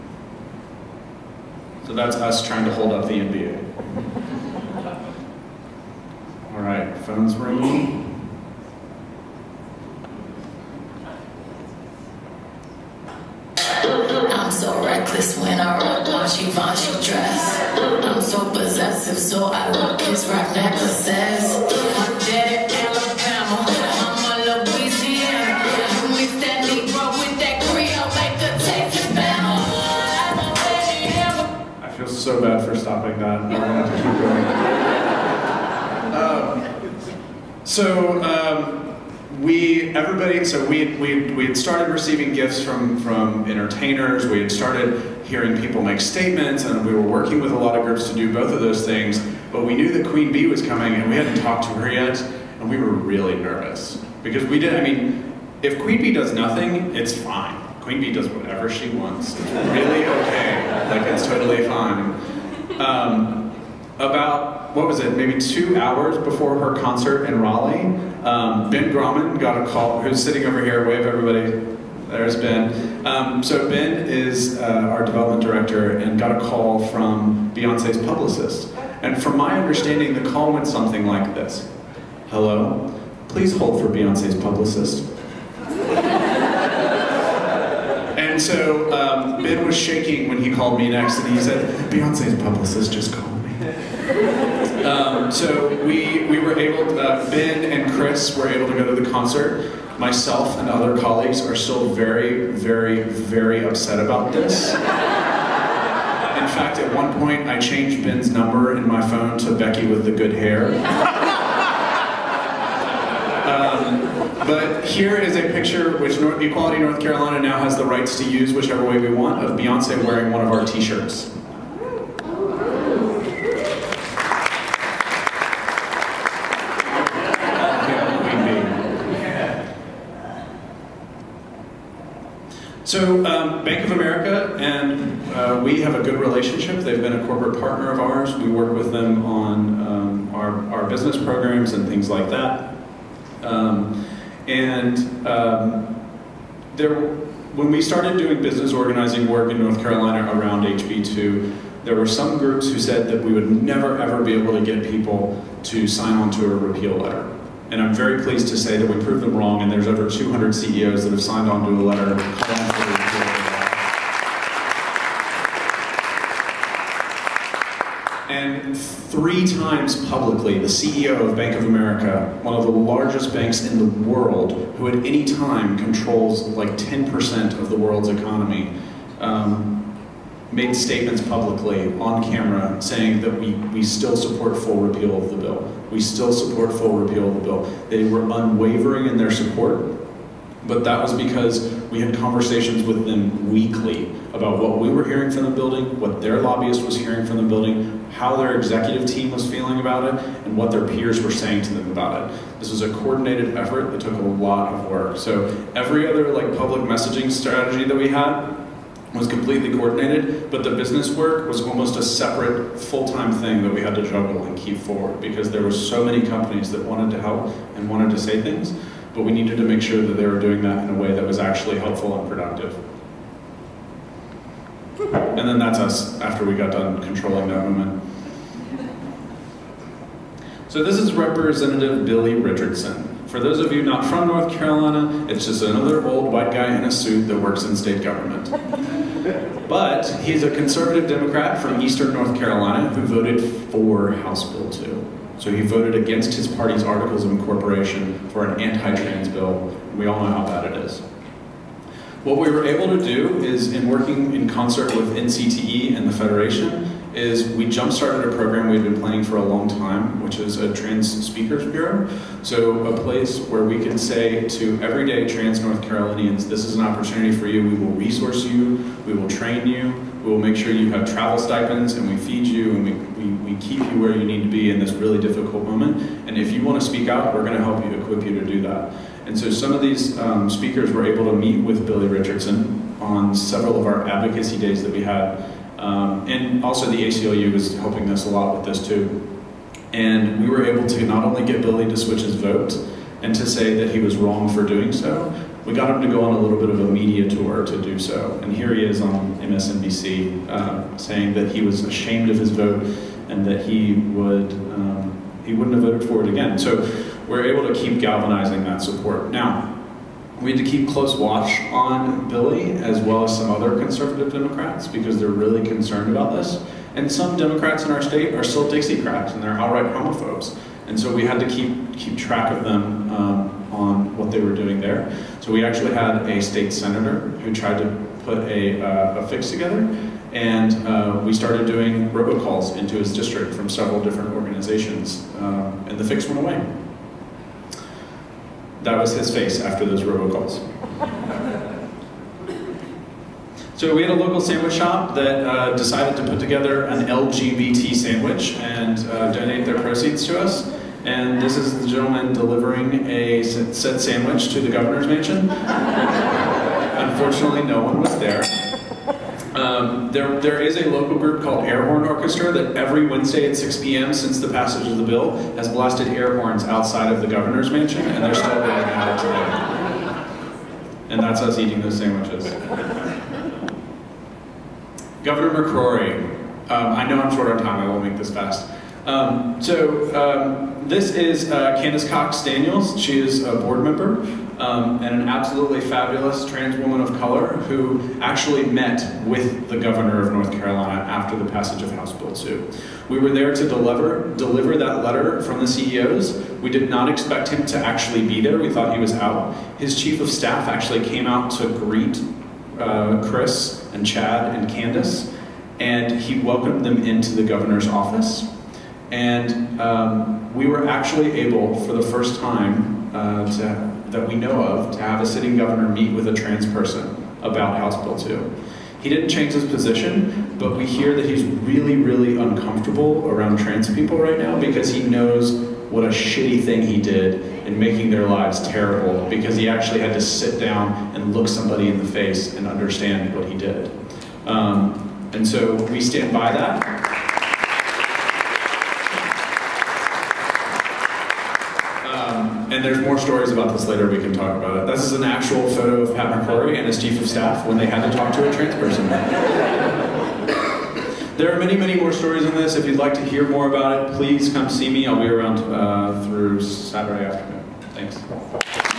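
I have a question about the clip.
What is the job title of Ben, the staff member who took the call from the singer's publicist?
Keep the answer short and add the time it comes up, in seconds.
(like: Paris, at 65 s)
development director, at 75 s.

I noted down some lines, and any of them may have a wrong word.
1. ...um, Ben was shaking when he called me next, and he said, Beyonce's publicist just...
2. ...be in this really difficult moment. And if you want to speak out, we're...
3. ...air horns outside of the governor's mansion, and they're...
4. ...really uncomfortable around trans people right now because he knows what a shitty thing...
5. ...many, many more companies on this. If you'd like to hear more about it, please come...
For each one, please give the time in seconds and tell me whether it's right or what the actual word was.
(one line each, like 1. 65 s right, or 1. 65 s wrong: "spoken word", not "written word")
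1. 88 s right
2. 274 s right
3. 366 s right
4. 421 s right
5. 451 s wrong: "stories", not "companies".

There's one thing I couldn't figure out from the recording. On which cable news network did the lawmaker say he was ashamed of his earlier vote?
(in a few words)
MSNBC.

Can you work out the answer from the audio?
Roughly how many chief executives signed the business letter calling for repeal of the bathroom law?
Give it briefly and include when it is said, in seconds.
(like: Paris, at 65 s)
over 200, at 159 s.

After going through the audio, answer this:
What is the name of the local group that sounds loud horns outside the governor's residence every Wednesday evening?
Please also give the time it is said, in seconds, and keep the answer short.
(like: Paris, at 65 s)
Air Horn Orchestra, at 361 s.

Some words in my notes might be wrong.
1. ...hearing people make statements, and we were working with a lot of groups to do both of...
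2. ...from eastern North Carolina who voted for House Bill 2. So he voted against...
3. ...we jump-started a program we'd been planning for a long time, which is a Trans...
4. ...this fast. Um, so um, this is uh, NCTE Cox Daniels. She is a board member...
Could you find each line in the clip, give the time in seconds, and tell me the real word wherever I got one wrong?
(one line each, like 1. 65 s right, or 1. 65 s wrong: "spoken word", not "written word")
1. 45 s right
2. 241 s right
3. 257 s right
4. 378 s wrong: "Candace", not "NCTE".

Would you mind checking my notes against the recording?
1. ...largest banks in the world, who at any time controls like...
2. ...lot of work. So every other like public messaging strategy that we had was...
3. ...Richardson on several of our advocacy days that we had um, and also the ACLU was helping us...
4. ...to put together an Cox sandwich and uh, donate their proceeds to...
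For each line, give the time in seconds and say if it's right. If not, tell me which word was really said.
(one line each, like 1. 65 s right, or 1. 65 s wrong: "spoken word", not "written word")
1. 172 s right
2. 204 s right
3. 282 s right
4. 346 s wrong: "LGBT", not "Cox".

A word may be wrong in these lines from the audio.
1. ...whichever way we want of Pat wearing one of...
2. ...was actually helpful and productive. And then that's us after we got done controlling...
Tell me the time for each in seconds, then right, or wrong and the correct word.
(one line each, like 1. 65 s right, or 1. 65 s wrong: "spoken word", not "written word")
1. 118 s wrong: "Beyonce", not "Pat"
2. 221 s right.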